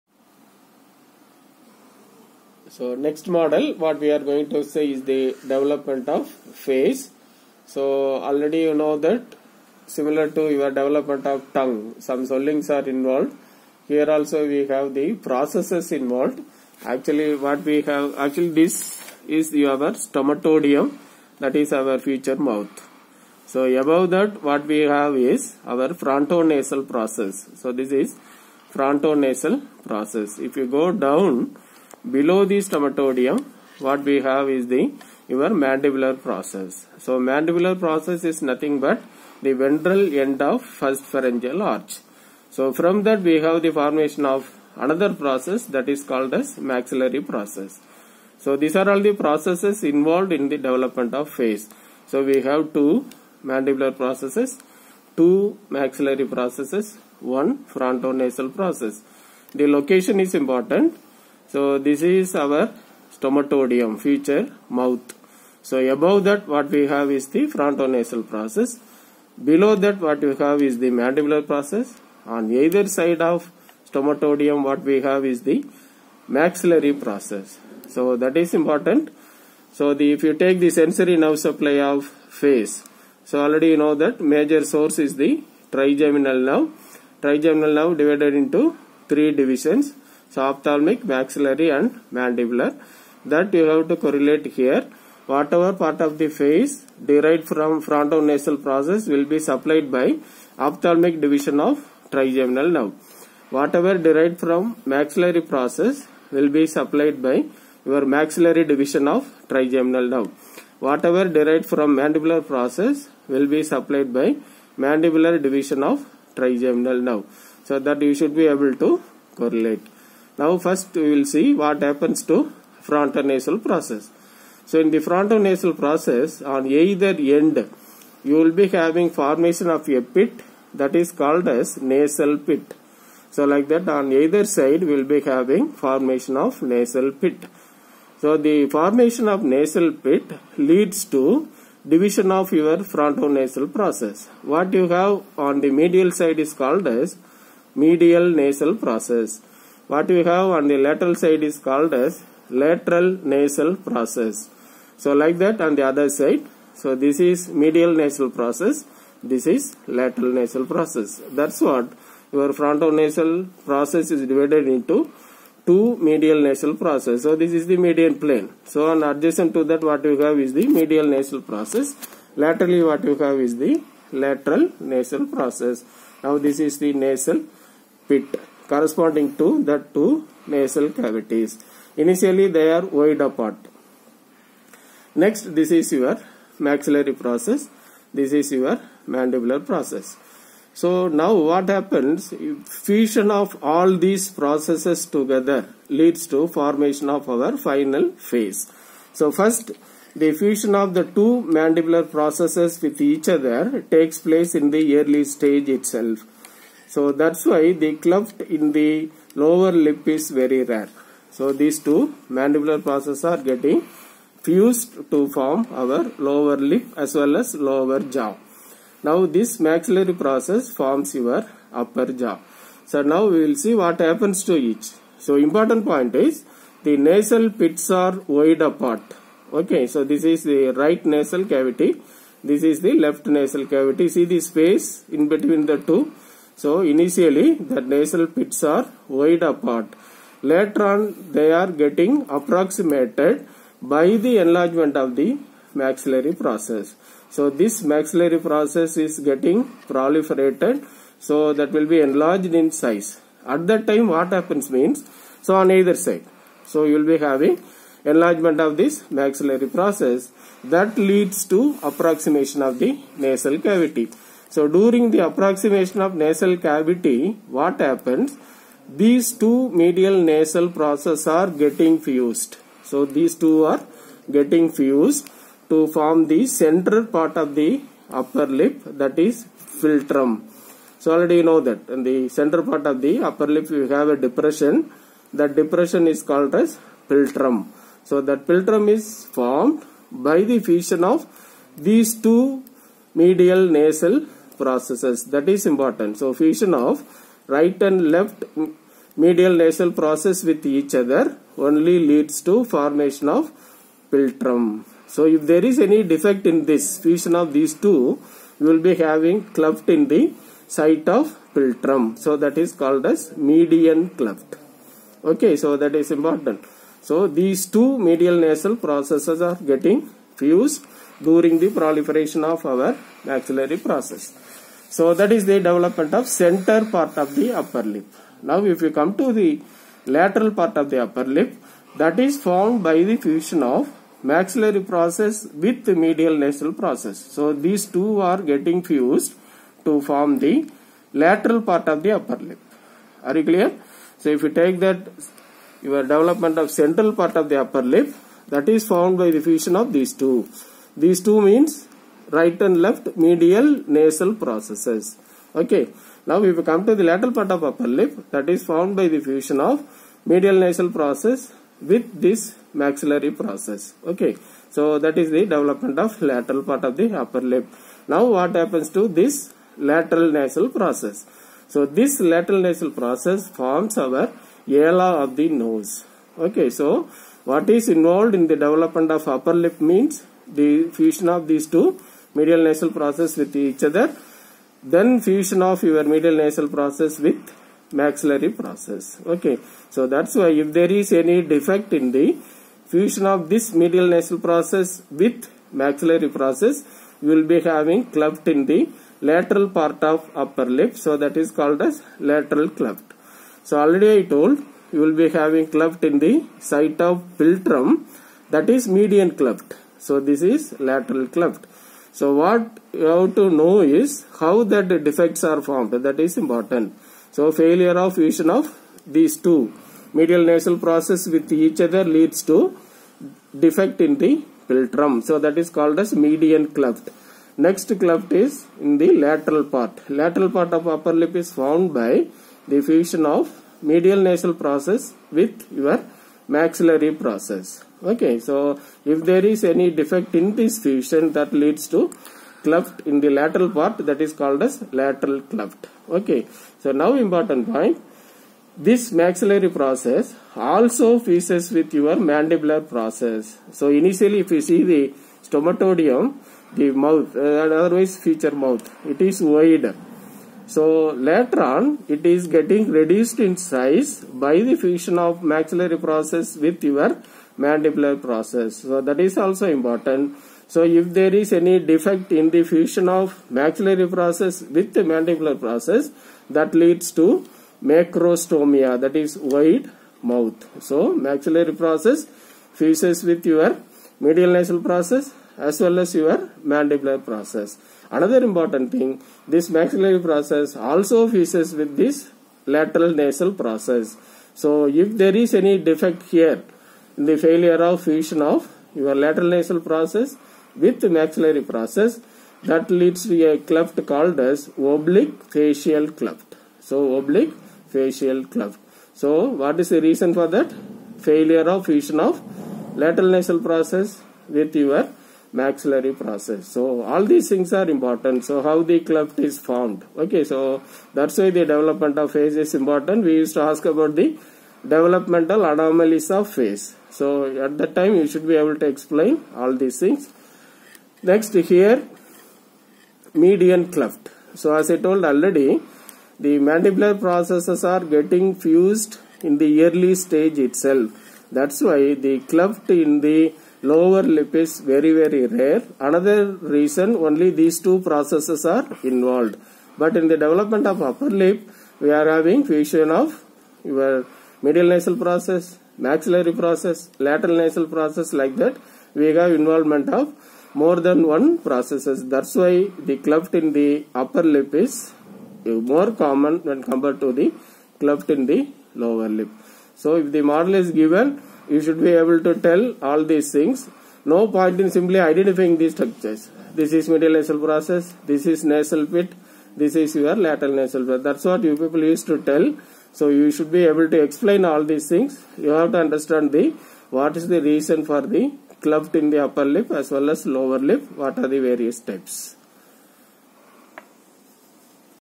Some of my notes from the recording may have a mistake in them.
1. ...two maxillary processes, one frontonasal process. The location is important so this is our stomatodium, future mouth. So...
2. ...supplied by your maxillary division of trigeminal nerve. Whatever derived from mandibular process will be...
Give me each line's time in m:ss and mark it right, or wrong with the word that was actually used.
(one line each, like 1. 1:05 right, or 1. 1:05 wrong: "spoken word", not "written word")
1. 0:55 right
2. 1:46 right.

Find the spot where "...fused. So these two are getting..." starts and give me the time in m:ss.
4:32.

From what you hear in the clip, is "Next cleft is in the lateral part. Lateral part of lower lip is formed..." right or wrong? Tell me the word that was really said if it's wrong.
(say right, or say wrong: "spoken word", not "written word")
wrong: "upper", not "lower".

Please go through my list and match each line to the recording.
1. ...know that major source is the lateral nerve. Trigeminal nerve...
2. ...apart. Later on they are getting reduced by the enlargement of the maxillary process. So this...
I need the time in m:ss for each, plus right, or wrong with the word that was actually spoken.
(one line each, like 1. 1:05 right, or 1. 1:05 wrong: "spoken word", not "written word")
1. 1:23 wrong: "trigeminal", not "lateral"
2. 3:59 wrong: "approximated", not "reduced".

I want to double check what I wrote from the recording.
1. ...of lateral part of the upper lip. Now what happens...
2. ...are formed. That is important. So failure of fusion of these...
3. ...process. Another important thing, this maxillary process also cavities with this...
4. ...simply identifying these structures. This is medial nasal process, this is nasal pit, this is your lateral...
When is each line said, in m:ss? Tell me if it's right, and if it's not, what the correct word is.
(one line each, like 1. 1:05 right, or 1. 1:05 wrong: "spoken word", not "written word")
1. 6:05 right
2. 6:55 right
3. 8:07 wrong: "fuses", not "cavities"
4. 9:34 right.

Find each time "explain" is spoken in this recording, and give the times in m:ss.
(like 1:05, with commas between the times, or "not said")
8:48, 9:44.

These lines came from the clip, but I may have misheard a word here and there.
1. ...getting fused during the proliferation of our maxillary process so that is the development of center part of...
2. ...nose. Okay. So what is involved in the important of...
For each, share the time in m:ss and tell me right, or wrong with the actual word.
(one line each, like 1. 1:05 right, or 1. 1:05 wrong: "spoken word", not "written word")
1. 5:19 right
2. 6:15 wrong: "development", not "important".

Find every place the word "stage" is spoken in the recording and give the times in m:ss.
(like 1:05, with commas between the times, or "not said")
3:25, 9:00.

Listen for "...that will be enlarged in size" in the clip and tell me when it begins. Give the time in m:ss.
4:11.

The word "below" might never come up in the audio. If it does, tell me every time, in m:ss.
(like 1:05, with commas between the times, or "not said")
0:32, 1:09.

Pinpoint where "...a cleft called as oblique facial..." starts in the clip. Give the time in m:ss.
8:23.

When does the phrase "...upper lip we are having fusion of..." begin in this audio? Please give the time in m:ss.
9:11.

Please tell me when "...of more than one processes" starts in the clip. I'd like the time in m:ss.
9:20.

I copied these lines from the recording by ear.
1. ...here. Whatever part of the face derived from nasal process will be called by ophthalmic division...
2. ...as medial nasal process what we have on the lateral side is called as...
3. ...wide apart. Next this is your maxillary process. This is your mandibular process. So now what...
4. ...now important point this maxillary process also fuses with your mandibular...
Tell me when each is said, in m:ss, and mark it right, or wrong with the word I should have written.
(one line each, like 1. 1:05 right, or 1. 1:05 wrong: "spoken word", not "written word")
1. 1:34 wrong: "supplied", not "called"
2. 2:26 right
3. 3:02 right
4. 7:26 right.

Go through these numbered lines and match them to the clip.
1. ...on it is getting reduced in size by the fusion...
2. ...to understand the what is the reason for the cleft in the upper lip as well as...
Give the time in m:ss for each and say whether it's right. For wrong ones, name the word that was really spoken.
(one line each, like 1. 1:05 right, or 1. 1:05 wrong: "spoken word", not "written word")
1. 7:41 right
2. 9:45 right.